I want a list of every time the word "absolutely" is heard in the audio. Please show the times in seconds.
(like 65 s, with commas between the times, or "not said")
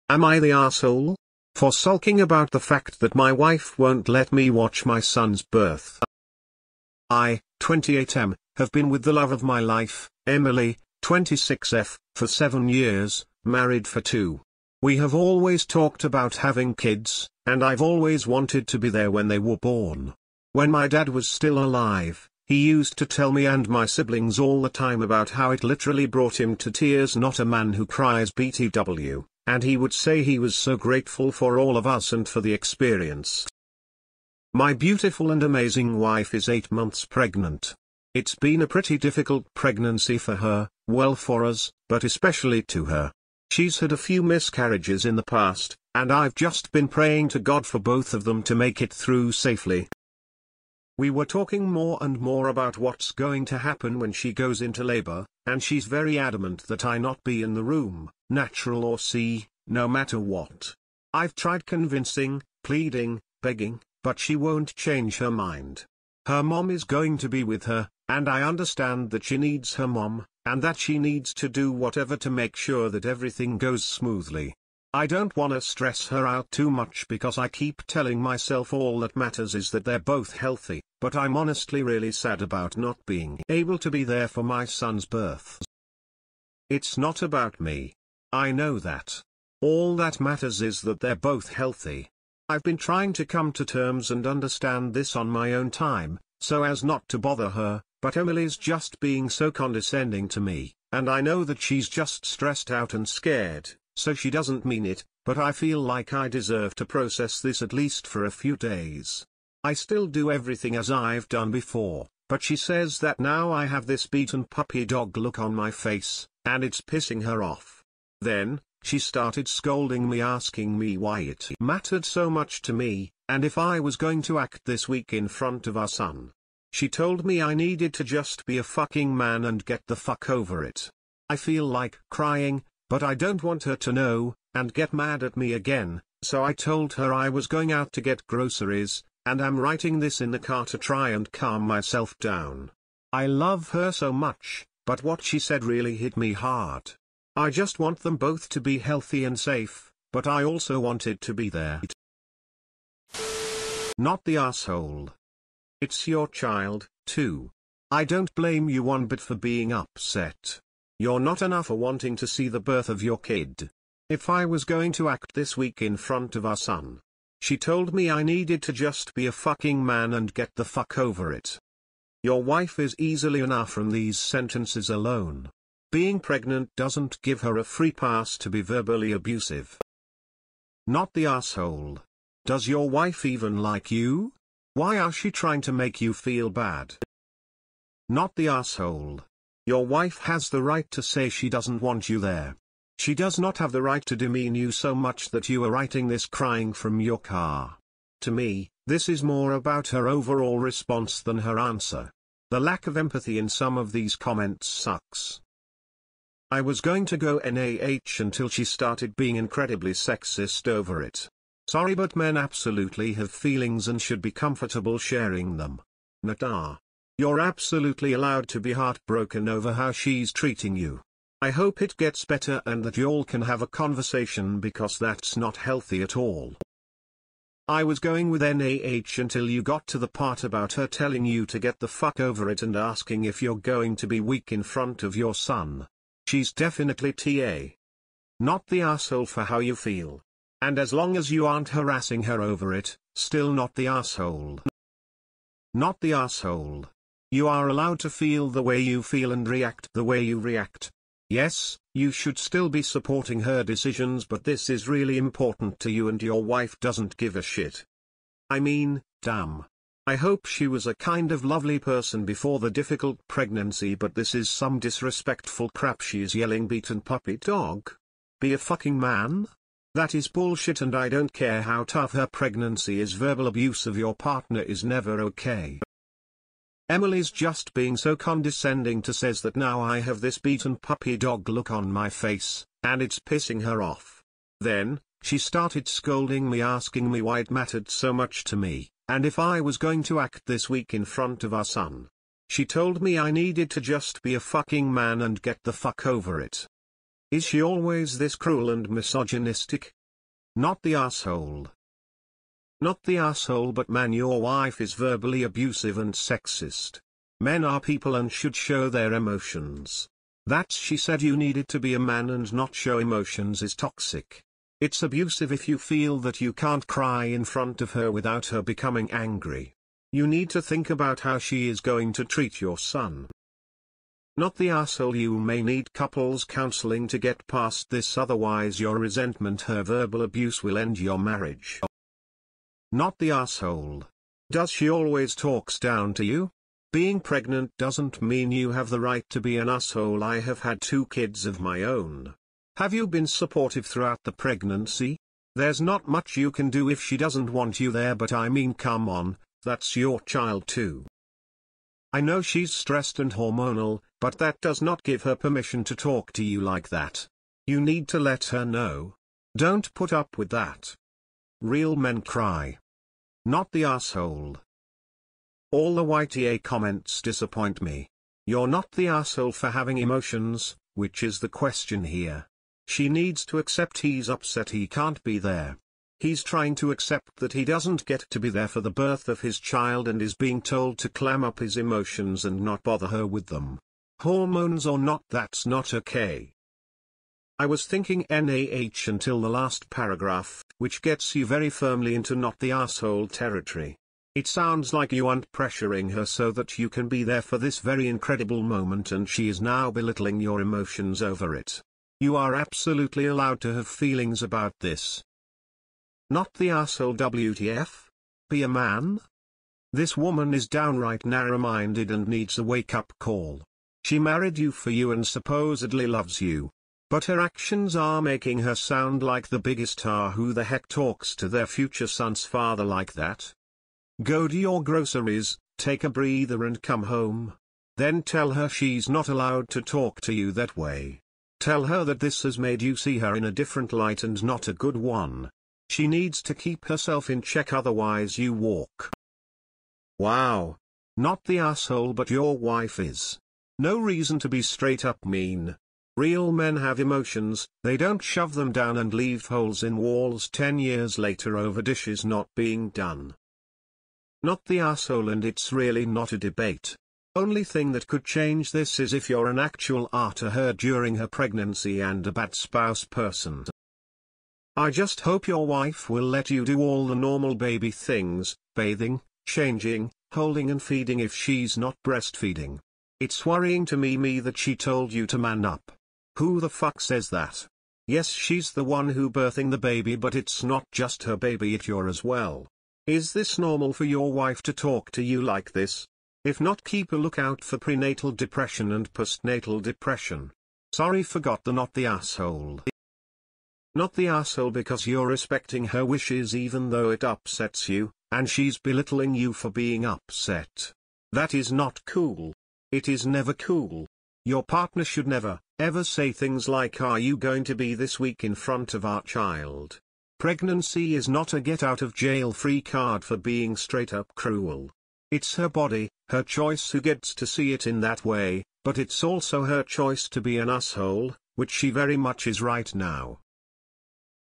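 212 s, 217 s, 402 s.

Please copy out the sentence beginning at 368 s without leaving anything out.
You're not the asshole for having emotions, which is the question here.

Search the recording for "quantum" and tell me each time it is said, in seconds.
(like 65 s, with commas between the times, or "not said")
not said.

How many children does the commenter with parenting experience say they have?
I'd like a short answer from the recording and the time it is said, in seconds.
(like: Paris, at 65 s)
2, at 340 s.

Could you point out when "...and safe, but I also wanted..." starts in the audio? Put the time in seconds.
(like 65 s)
149 s.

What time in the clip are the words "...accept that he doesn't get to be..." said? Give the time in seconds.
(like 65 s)
376 s.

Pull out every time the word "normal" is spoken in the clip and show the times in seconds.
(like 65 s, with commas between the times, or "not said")
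467 s, 483 s.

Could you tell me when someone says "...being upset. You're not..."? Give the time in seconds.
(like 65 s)
159 s.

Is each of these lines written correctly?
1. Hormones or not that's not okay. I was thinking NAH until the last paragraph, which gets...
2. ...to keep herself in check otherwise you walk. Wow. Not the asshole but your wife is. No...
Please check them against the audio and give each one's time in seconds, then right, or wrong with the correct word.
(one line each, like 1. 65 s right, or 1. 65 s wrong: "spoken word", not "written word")
1. 384 s right
2. 436 s right.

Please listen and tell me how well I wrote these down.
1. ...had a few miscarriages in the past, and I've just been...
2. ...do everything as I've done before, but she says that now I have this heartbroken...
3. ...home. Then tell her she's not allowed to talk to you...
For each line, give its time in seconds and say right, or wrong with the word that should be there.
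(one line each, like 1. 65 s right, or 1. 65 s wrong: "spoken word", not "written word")
1. 43 s right
2. 110 s wrong: "beaten", not "heartbroken"
3. 427 s right.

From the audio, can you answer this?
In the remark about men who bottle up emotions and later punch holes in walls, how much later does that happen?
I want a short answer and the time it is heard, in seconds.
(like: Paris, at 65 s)
10 years, at 450 s.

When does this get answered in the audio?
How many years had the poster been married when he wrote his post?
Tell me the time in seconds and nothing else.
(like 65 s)
13 s.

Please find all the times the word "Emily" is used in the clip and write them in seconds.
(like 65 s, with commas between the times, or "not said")
10 s, 98 s, 276 s.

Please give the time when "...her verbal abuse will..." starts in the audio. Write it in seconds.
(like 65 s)
329 s.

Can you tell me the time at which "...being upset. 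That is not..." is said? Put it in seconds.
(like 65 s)
499 s.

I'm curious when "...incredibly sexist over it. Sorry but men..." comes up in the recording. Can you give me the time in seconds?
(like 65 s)
209 s.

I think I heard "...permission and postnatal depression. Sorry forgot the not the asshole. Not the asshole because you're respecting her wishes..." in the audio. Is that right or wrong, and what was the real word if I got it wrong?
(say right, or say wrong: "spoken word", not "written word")
wrong: "depression", not "permission".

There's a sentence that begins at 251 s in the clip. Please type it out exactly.
Yes, you should still be supporting her decisions but this is really important to you and your wife doesn't give a shit.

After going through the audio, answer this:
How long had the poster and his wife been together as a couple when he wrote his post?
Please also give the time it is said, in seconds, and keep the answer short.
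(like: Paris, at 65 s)
seven years, at 12 s.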